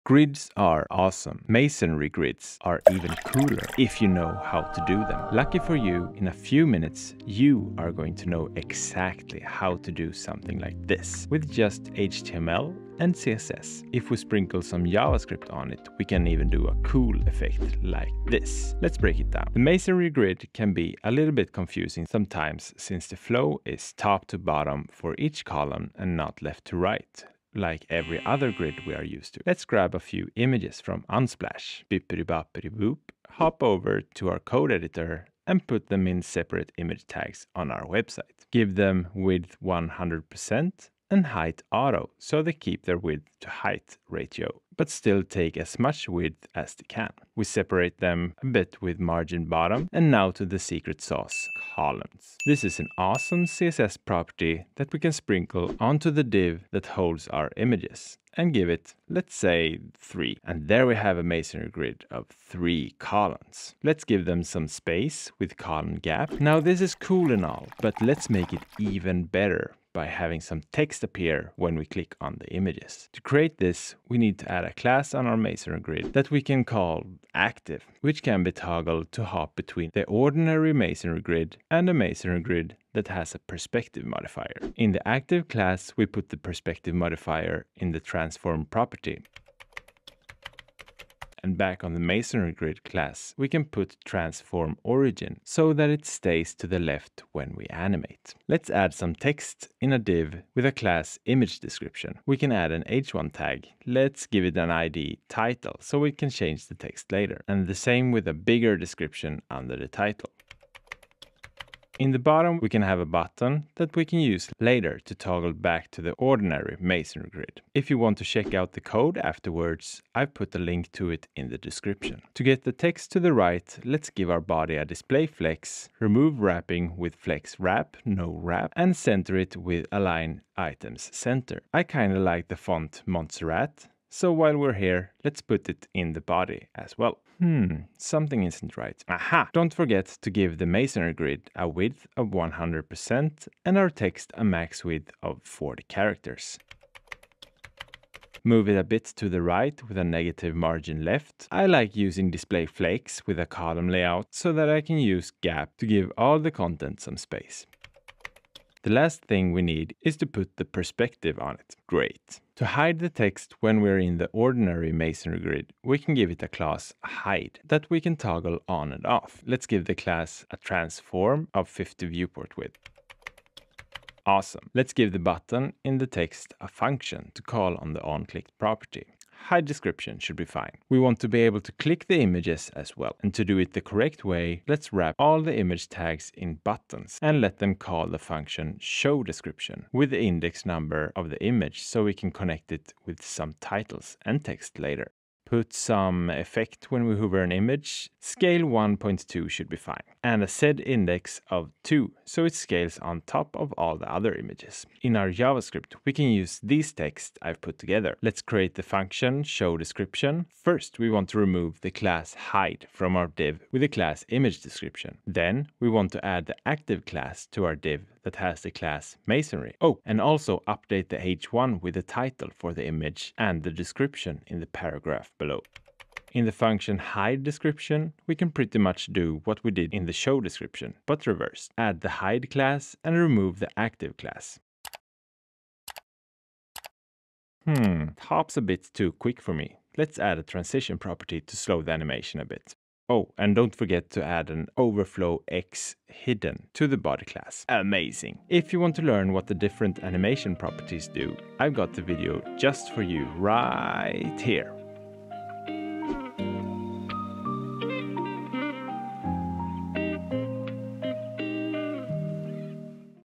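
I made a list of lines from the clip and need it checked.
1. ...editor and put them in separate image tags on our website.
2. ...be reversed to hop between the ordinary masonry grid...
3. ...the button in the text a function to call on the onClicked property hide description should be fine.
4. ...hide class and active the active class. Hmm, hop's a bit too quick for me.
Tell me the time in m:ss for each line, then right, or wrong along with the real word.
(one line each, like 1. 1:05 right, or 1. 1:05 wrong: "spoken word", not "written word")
1. 0:34 right
2. 1:18 wrong: "toggled", not "reversed"
3. 2:55 right
4. 3:52 wrong: "remove", not "active".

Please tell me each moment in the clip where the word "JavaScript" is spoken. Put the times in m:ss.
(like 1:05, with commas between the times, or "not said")
0:14, 3:25.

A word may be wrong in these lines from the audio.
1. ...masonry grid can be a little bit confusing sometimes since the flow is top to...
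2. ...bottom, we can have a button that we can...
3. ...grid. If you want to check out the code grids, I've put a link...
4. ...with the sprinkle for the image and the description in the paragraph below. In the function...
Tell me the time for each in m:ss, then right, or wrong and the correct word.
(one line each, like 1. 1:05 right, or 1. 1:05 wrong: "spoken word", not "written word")
1. 0:19 right
2. 1:52 right
3. 1:57 wrong: "afterwards", not "grids"
4. 3:41 wrong: "title", not "sprinkle".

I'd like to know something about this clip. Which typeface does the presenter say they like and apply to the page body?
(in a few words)
Montserrat.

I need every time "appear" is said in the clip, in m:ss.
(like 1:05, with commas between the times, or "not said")
1:11.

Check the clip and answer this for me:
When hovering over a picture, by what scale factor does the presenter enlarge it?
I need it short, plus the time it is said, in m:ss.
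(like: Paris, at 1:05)
1.2, at 3:18.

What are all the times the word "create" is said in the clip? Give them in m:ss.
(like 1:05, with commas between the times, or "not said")
1:13, 3:28.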